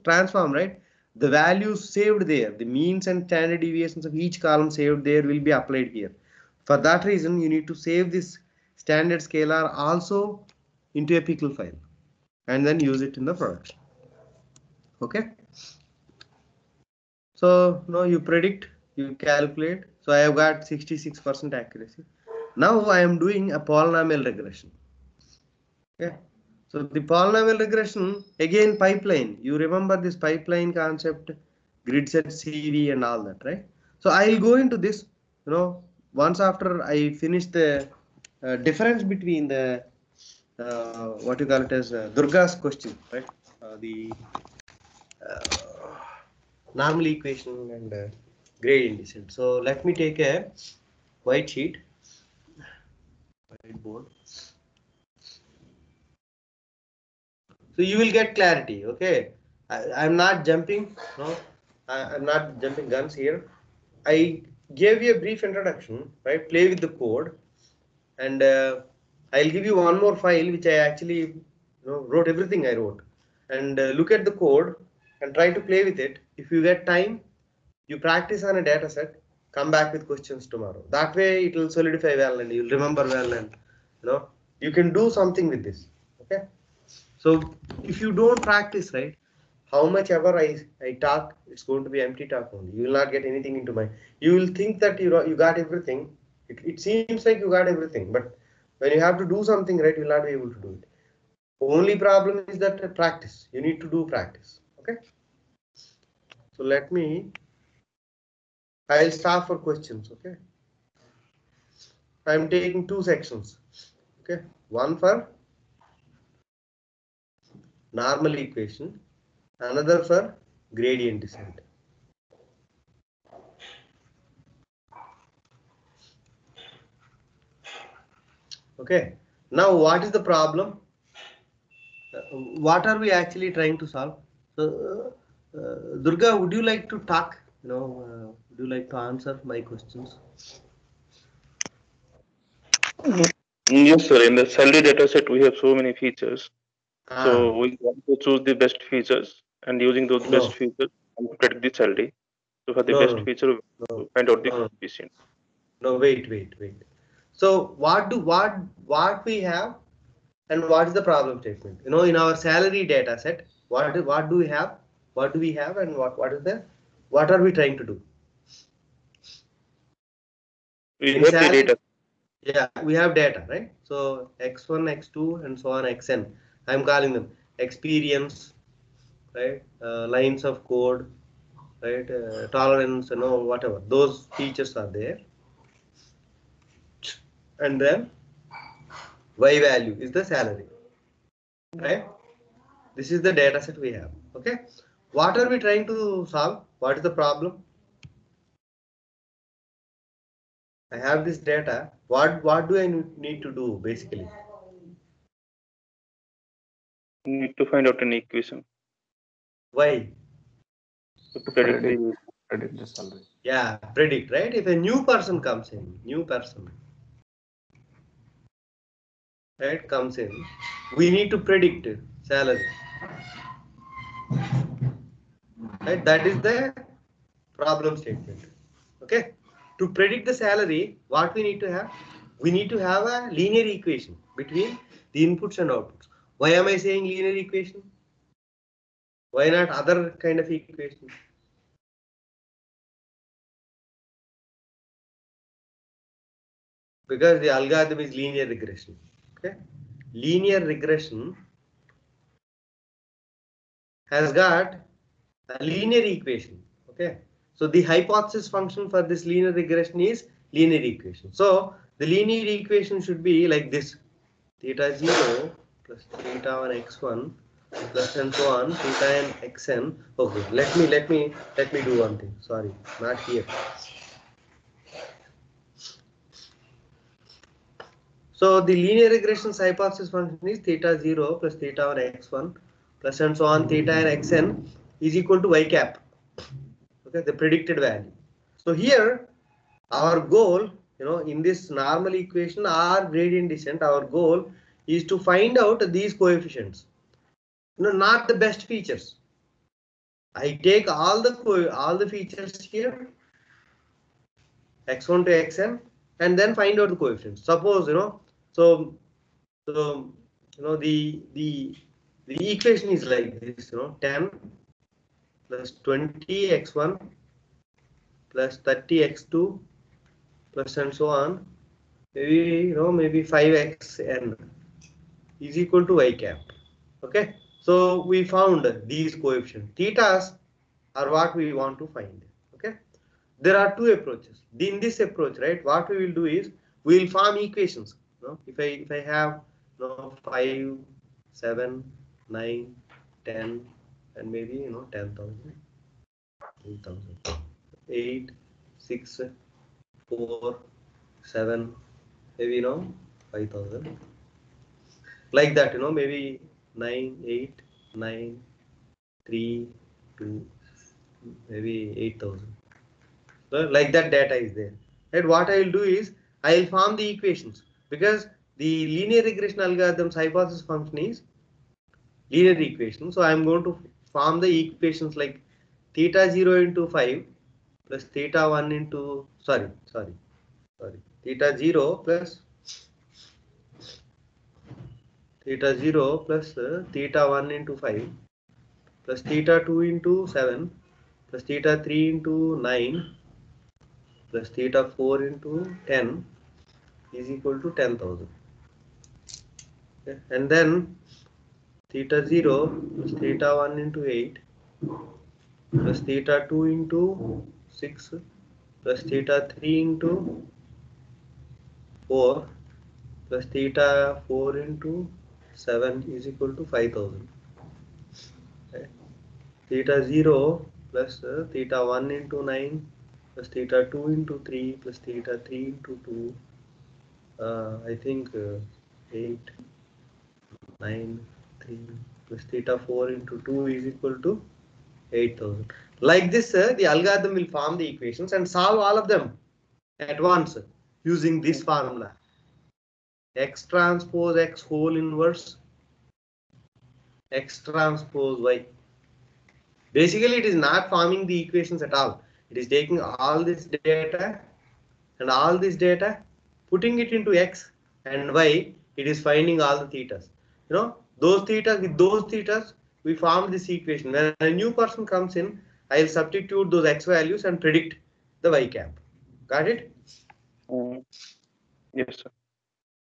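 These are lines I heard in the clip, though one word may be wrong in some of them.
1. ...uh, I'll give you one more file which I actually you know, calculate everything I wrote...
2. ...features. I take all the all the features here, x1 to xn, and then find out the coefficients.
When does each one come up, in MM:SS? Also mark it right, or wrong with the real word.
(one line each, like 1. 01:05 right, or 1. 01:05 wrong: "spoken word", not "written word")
1. 01:08 wrong: "wrote", not "calculate"
2. 04:58 right.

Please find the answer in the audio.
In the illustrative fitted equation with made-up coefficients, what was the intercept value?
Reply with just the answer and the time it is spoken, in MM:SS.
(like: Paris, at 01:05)
10, at 05:14.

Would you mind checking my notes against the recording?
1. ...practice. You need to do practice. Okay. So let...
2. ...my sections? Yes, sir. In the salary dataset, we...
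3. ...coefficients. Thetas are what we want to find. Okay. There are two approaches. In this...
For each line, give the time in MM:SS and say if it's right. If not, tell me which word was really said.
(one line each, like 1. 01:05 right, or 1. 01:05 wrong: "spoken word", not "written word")
1. 01:42 right
2. 02:19 wrong: "questions", not "sections"
3. 05:29 right.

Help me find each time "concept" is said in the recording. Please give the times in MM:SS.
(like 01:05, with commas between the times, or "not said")
00:30.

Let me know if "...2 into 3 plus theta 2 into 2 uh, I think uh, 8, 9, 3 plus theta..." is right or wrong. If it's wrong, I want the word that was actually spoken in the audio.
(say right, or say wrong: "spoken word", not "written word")
wrong: "3", not "2".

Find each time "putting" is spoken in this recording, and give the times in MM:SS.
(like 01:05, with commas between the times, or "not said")
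07:36.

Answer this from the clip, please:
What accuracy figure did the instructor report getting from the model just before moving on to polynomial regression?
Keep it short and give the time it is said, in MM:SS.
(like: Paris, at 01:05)
66%, at 00:20.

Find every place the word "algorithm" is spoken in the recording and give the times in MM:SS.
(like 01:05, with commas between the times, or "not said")
04:07, 06:09, 07:16.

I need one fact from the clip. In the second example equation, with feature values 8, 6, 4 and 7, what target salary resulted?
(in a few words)
5000.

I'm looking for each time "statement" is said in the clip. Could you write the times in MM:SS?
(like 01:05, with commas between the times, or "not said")
02:41, 03:47.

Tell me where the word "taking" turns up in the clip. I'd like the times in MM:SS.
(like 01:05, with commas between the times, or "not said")
01:52, 07:32.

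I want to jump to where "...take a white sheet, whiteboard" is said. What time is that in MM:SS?
00:49.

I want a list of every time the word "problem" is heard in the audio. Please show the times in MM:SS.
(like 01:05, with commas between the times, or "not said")
01:41, 02:10, 02:41, 03:17, 03:47.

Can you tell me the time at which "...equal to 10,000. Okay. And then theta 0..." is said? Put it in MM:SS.
06:37.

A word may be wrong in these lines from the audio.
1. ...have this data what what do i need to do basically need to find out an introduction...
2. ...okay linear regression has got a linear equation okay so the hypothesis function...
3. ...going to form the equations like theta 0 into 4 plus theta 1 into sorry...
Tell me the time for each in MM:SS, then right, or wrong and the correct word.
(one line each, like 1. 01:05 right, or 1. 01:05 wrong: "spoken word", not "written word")
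1. 03:21 wrong: "equation", not "introduction"
2. 04:09 right
3. 06:13 wrong: "5", not "4".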